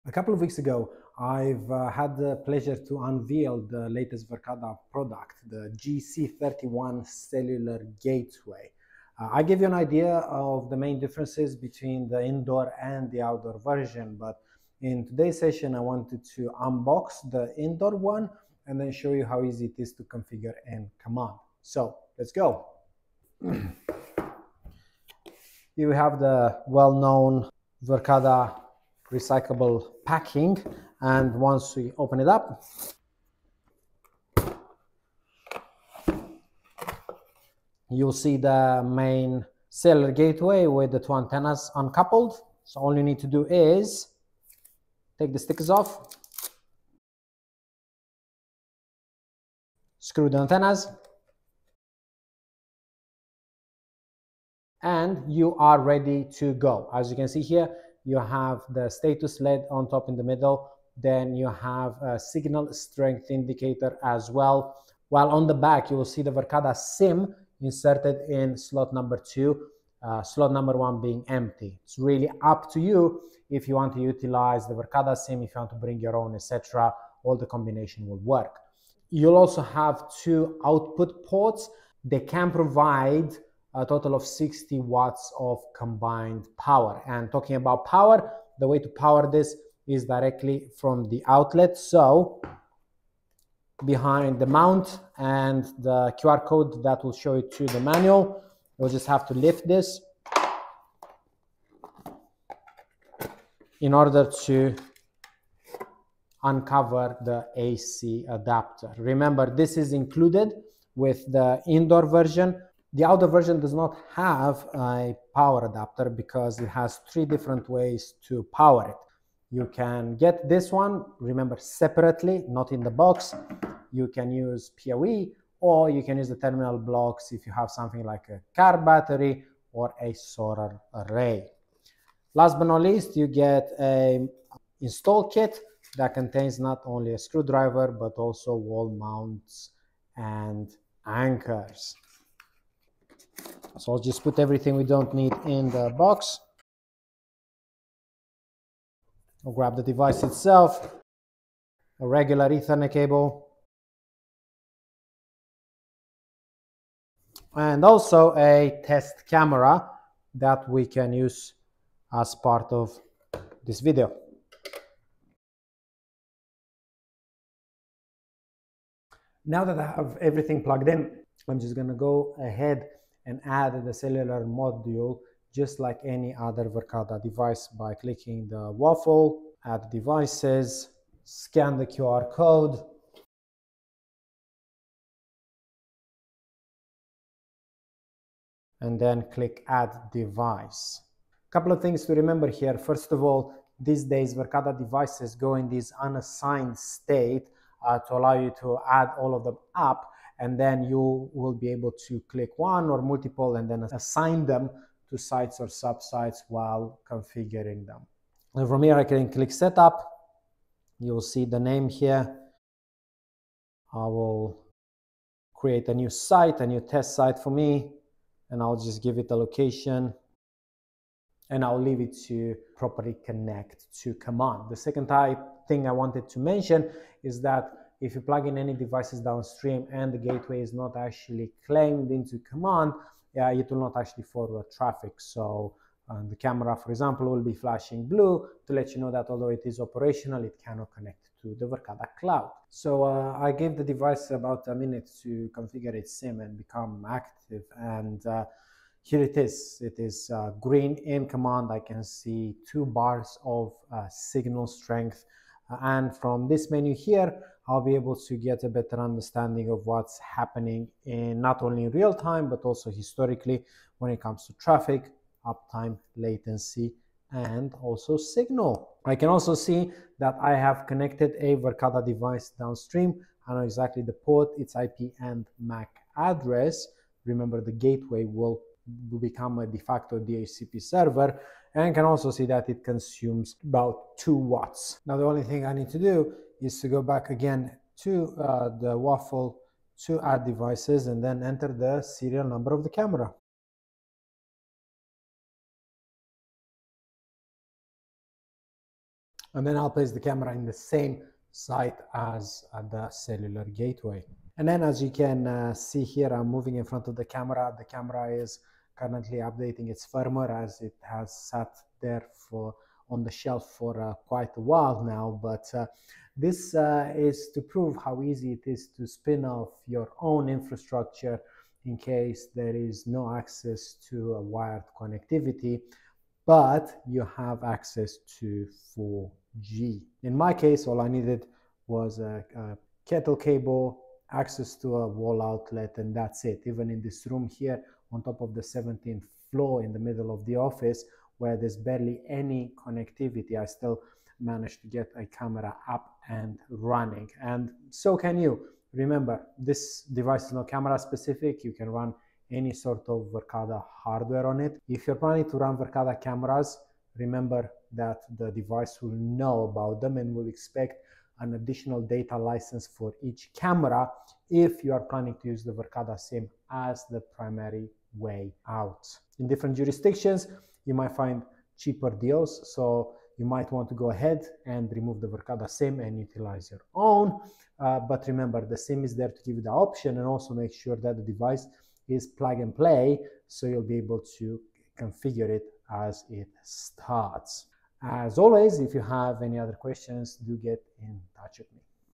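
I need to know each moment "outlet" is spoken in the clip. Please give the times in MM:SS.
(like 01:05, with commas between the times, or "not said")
01:31, 05:35.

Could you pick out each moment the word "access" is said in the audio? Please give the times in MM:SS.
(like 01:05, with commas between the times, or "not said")
05:23, 05:27, 05:34.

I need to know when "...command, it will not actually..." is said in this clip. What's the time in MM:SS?
03:52.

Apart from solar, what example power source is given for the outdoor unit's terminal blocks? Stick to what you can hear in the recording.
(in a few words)
Car battery.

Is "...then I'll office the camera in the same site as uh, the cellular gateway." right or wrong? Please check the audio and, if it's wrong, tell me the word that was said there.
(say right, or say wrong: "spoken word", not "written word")
wrong: "place", not "office".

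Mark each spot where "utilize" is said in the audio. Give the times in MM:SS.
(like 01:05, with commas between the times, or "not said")
01:14, 06:16.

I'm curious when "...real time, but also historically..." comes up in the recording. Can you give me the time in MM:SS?
04:21.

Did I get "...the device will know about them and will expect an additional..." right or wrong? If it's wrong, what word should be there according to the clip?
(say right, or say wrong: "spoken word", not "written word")
right.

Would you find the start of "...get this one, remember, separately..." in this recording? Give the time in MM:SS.
02:00.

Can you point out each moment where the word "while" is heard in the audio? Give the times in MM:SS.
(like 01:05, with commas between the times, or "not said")
01:05, 03:26, 05:14.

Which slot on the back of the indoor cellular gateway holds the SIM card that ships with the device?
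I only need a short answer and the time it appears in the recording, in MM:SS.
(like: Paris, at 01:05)
Slot 2, at 01:08.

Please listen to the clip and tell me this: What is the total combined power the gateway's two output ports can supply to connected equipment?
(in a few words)
60 watts.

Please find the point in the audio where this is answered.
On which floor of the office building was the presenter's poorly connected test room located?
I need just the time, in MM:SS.
05:38.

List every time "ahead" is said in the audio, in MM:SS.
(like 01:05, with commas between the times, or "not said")
02:52, 06:14.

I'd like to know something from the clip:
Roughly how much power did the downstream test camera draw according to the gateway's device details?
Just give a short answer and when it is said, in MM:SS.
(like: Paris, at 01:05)
2 watts, at 04:44.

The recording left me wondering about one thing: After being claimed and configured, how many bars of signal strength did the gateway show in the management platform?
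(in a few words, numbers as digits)
2.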